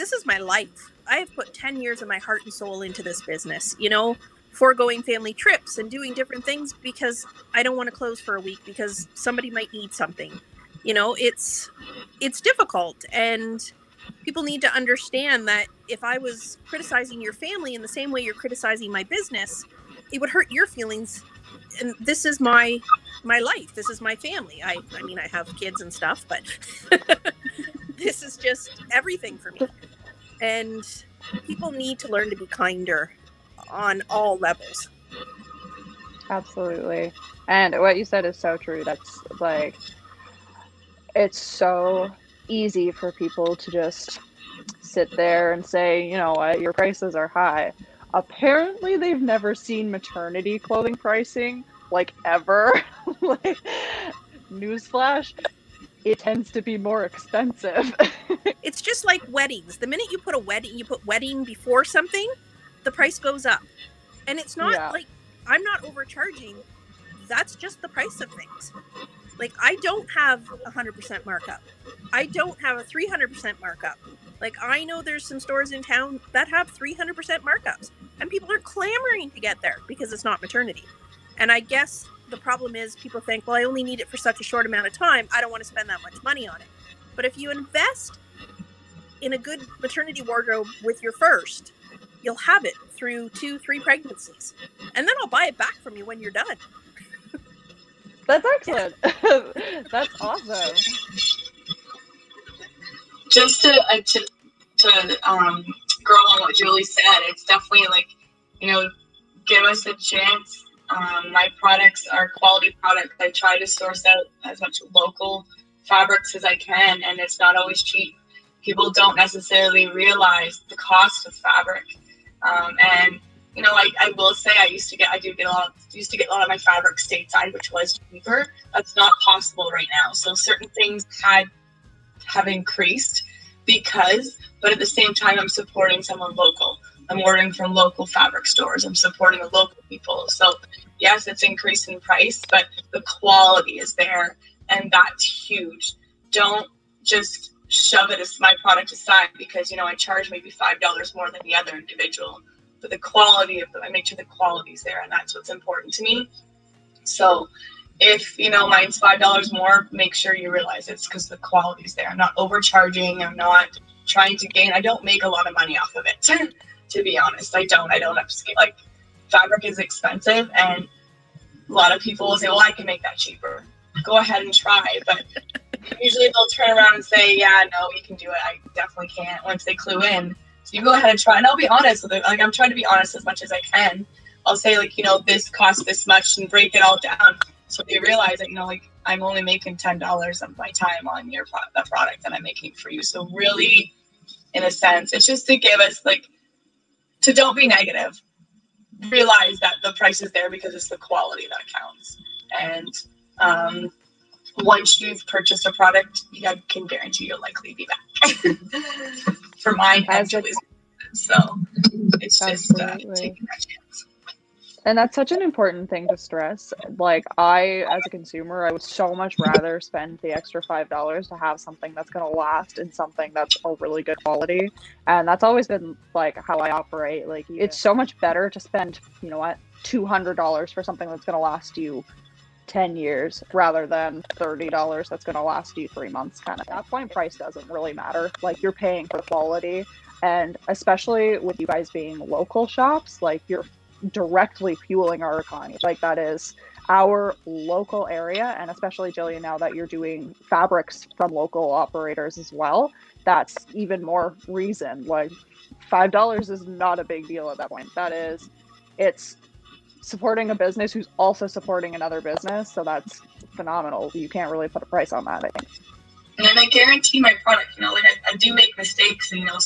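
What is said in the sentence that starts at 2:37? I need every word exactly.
So, if you know mine's five dollars more, make sure you realize it's because the quality's there.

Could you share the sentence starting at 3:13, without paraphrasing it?
So really, in a sense, it's just to give us like to don't be negative.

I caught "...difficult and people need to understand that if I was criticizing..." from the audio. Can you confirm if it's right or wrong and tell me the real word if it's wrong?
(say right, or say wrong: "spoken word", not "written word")
right.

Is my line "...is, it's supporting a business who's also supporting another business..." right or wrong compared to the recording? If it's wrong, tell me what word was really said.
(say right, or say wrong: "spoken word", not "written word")
right.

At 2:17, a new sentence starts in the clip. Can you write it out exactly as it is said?
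I'm ordering from local fabric stores.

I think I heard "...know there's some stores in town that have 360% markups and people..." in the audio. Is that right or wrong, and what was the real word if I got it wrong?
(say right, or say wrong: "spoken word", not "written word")
wrong: "300", not "360".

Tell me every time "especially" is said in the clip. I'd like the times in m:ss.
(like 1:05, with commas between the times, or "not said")
4:00, 4:08.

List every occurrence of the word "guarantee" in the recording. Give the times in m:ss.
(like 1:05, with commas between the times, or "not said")
3:26, 4:26.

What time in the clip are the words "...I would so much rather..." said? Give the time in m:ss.
3:38.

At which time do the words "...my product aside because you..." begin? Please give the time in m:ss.
2:28.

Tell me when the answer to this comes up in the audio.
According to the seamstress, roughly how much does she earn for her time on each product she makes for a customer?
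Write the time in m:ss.
3:09.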